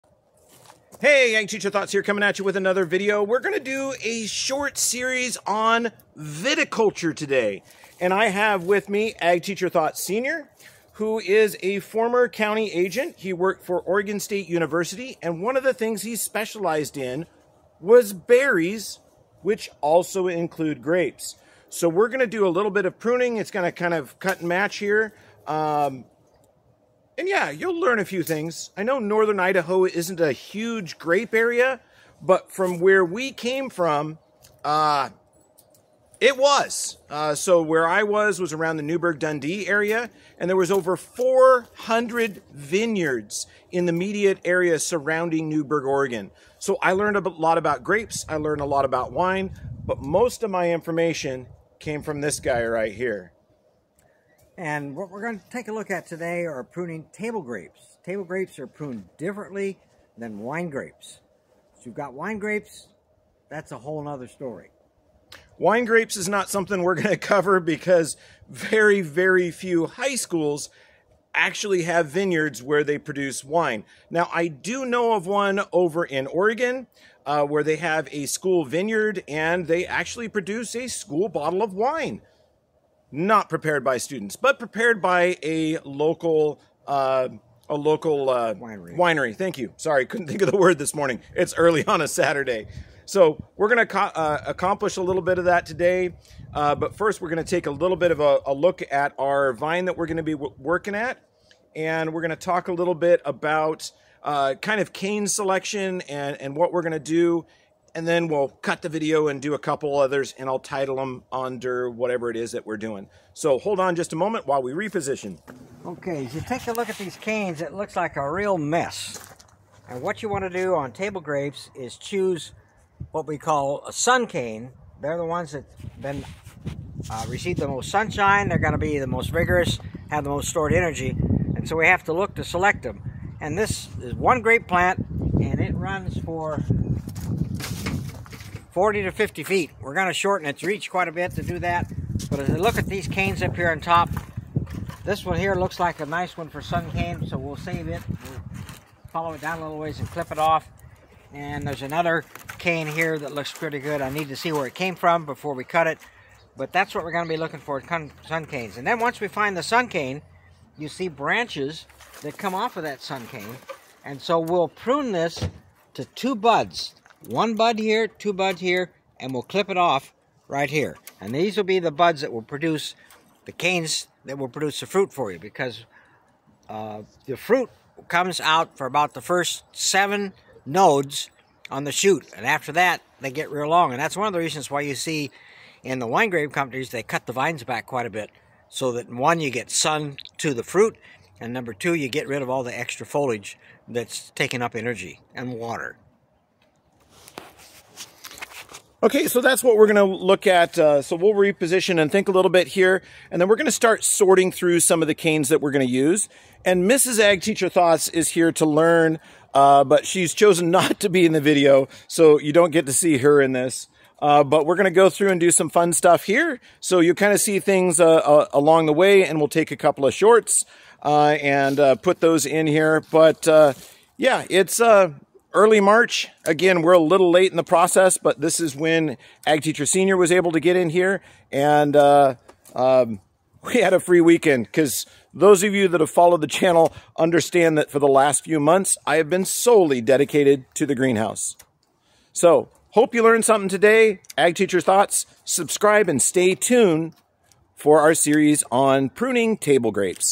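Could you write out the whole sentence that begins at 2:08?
They're going to be the most vigorous, have the most stored energy.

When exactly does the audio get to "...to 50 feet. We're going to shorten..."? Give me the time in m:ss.
2:19.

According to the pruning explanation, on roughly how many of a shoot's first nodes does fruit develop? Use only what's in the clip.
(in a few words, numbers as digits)
7.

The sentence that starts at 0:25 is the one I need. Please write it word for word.
Um, and yeah, you'll learn a few things.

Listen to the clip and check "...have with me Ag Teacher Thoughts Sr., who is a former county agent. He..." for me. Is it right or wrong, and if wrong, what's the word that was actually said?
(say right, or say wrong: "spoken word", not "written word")
right.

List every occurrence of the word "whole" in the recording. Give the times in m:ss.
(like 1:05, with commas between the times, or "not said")
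1:03.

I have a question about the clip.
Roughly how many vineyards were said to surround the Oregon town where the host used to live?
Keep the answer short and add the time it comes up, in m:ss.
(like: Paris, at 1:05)
over 400, at 0:40.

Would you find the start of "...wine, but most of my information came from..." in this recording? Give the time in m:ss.
0:49.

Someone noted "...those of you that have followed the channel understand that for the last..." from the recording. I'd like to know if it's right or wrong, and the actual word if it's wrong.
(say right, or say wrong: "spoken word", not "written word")
right.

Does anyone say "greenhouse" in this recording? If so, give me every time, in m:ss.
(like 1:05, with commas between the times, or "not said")
4:00.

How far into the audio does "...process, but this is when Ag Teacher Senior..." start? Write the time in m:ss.
3:47.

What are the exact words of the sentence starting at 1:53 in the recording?
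So hold on just a moment while we reposition.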